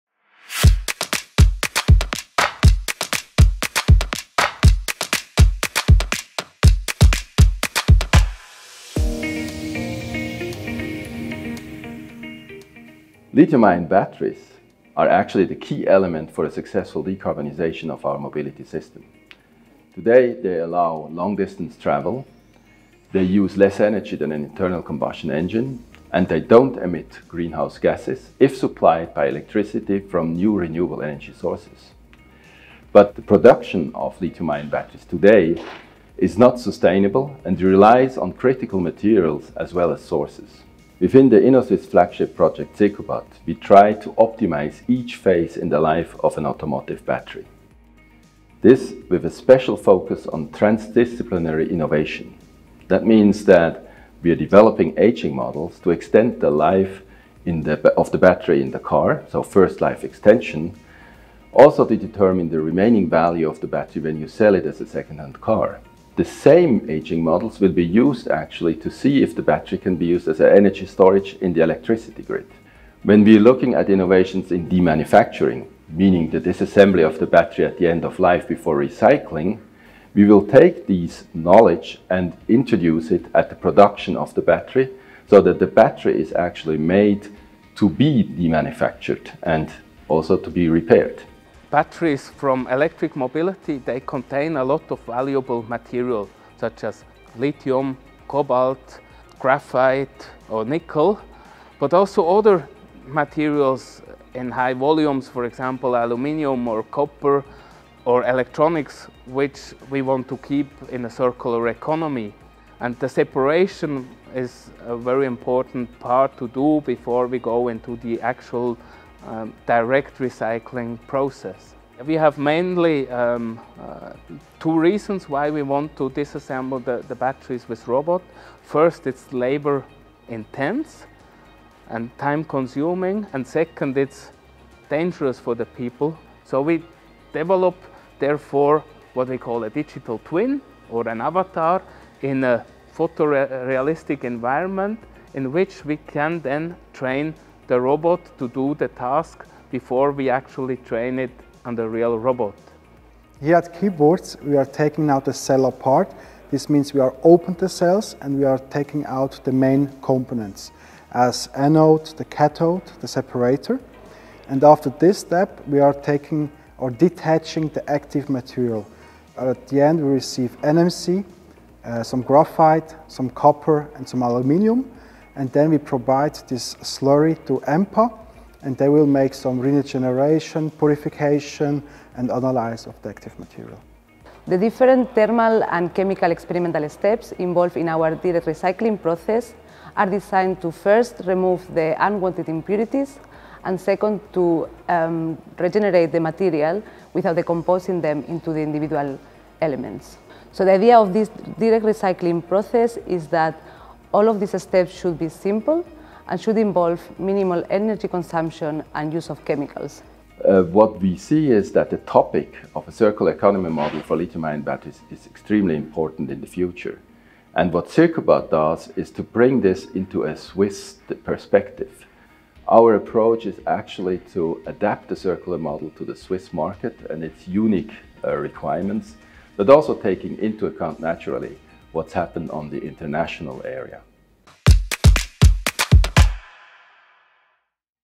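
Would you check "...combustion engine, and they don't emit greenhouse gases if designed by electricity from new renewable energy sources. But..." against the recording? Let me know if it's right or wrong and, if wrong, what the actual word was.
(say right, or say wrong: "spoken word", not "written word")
wrong: "supplied", not "designed".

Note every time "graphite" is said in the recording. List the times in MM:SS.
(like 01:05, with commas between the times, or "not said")
01:39, 02:52.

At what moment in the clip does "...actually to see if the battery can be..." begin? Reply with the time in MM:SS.
01:08.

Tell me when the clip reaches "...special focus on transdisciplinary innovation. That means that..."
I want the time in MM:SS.
00:49.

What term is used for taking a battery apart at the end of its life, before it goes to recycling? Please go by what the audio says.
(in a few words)
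Demanufacturing.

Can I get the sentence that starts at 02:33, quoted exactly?
Here at Kyburz, we are taking out the cell apart.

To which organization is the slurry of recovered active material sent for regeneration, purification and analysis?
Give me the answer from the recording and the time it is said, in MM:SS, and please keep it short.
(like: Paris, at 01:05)
EMPA, at 02:57.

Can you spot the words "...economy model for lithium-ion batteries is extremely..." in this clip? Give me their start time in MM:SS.
03:33.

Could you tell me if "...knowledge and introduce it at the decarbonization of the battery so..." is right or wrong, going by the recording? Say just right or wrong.
wrong.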